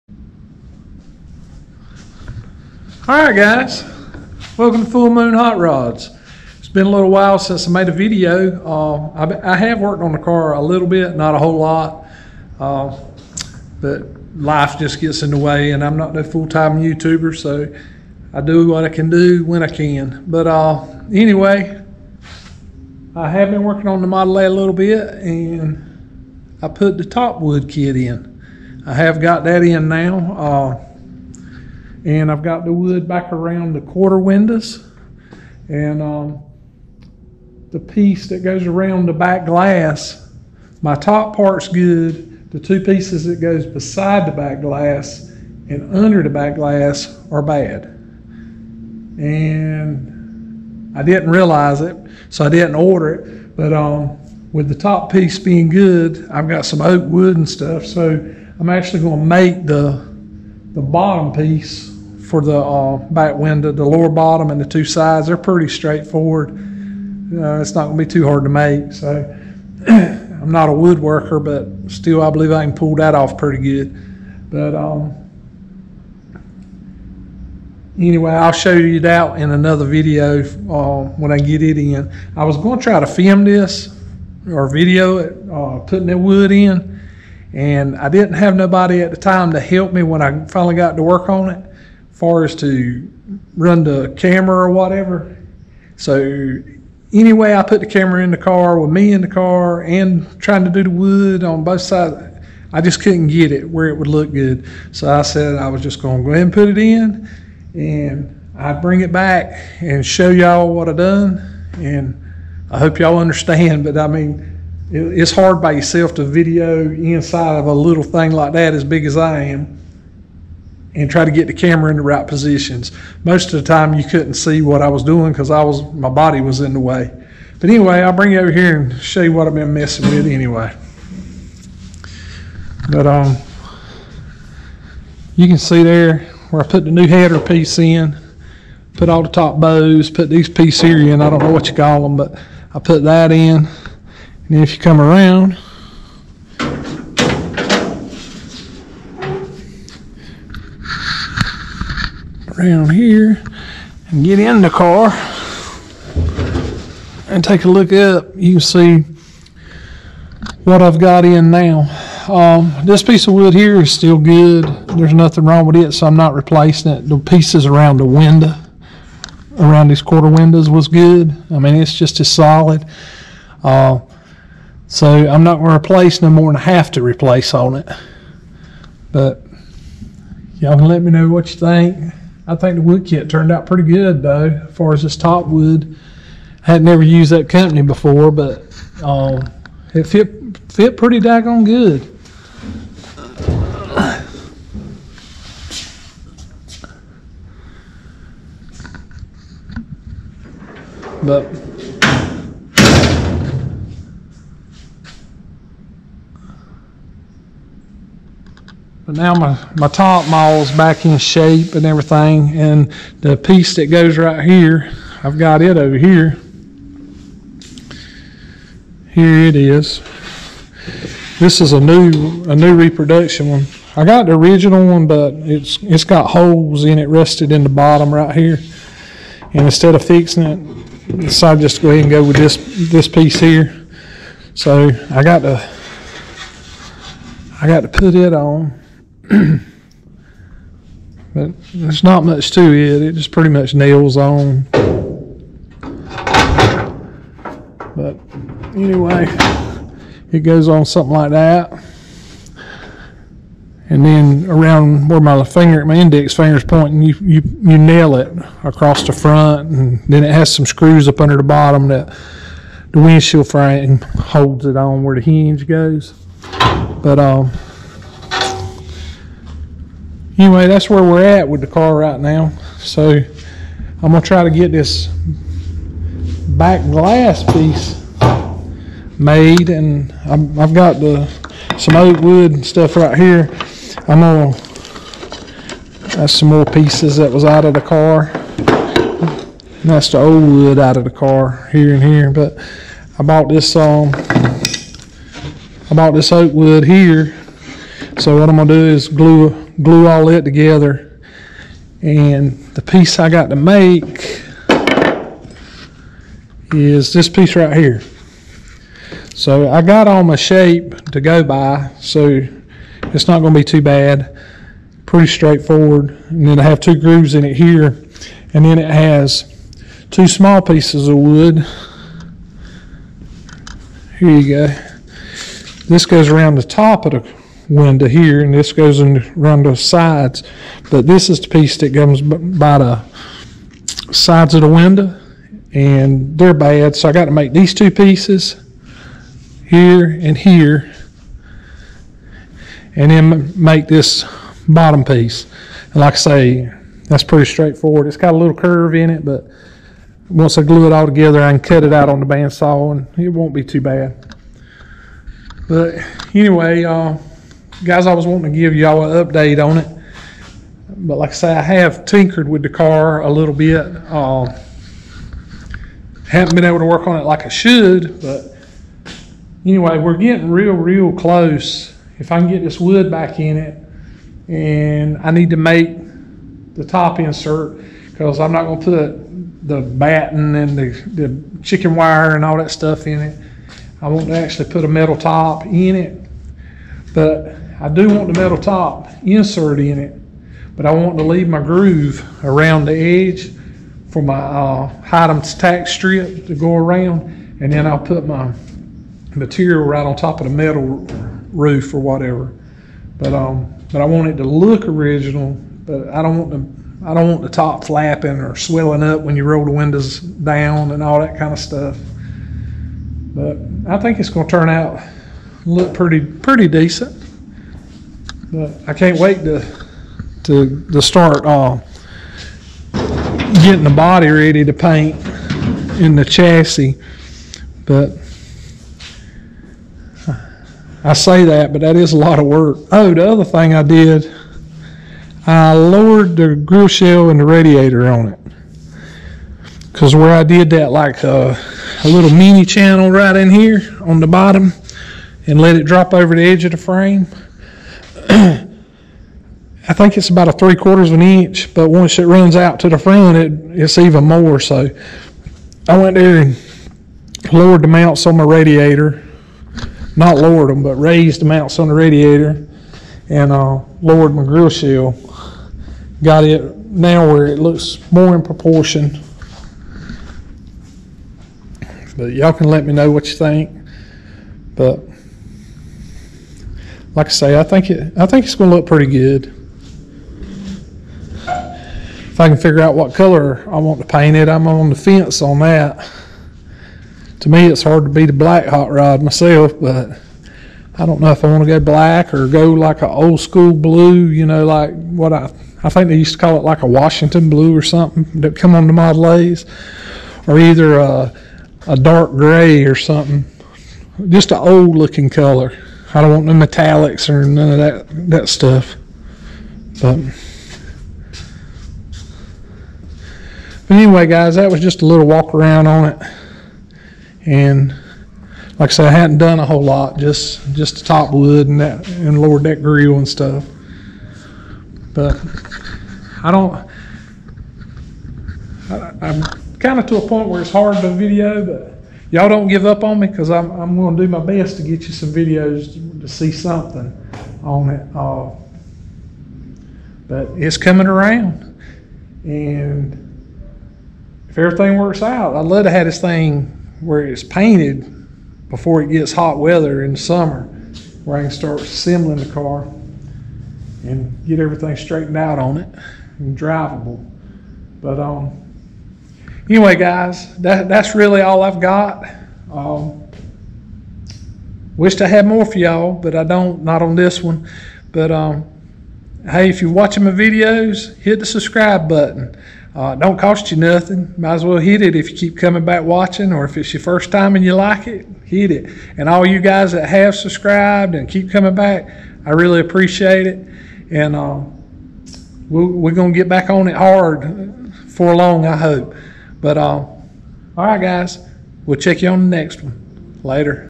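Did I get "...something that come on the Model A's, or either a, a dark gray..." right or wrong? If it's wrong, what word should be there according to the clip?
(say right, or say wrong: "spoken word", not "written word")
right.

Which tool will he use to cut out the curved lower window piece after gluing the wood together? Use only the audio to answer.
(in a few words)
bandsaw.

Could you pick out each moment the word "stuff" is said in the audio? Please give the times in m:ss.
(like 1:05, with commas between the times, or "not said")
0:57, 4:42, 6:22, 6:51, 8:28, 8:43.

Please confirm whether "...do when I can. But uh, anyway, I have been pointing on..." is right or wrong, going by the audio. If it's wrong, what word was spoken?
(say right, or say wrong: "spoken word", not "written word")
wrong: "working", not "pointing".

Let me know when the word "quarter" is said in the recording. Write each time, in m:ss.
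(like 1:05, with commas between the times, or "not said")
0:33, 2:50, 7:30.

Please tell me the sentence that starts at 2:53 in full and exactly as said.
Uh, so I'm not going to replace no more than I have to replace on it.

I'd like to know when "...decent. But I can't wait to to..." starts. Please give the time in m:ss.
6:56.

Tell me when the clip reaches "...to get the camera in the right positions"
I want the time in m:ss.
2:01.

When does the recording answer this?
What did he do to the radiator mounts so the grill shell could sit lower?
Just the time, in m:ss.
7:40.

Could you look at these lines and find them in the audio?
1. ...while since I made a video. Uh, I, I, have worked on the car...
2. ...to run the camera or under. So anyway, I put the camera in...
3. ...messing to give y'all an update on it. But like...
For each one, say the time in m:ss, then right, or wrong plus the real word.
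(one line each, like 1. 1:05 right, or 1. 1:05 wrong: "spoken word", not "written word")
1. 0:07 right
2. 1:32 wrong: "whatever", not "under"
3. 5:58 wrong: "wanting", not "messing".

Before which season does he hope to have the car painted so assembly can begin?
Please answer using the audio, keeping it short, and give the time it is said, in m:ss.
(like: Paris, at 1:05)
summer, at 9:10.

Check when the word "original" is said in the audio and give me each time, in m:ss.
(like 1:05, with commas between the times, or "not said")
3:44, 6:44.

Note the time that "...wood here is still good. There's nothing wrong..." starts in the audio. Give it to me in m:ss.
2:43.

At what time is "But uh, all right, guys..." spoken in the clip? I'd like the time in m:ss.
9:49.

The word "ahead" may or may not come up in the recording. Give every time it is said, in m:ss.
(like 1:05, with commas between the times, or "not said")
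1:46, 3:51.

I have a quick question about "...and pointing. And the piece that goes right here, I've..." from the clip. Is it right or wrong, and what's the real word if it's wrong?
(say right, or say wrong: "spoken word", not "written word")
wrong: "everything", not "pointing".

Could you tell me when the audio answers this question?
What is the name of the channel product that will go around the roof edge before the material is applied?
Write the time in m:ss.
6:35.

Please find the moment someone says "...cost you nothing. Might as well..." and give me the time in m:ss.
9:33.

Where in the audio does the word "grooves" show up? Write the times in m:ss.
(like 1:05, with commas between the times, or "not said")
5:16, 6:31.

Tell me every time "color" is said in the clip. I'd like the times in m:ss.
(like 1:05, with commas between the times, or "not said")
8:03, 8:25.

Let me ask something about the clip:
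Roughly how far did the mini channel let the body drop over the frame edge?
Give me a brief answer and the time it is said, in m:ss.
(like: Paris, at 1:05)
3/4 inch, at 7:30.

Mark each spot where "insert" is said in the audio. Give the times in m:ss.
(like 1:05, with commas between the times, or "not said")
6:17, 6:29.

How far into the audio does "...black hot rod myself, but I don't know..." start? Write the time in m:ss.
8:08.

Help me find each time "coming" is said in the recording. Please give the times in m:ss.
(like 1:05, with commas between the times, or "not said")
9:00, 9:35, 9:41.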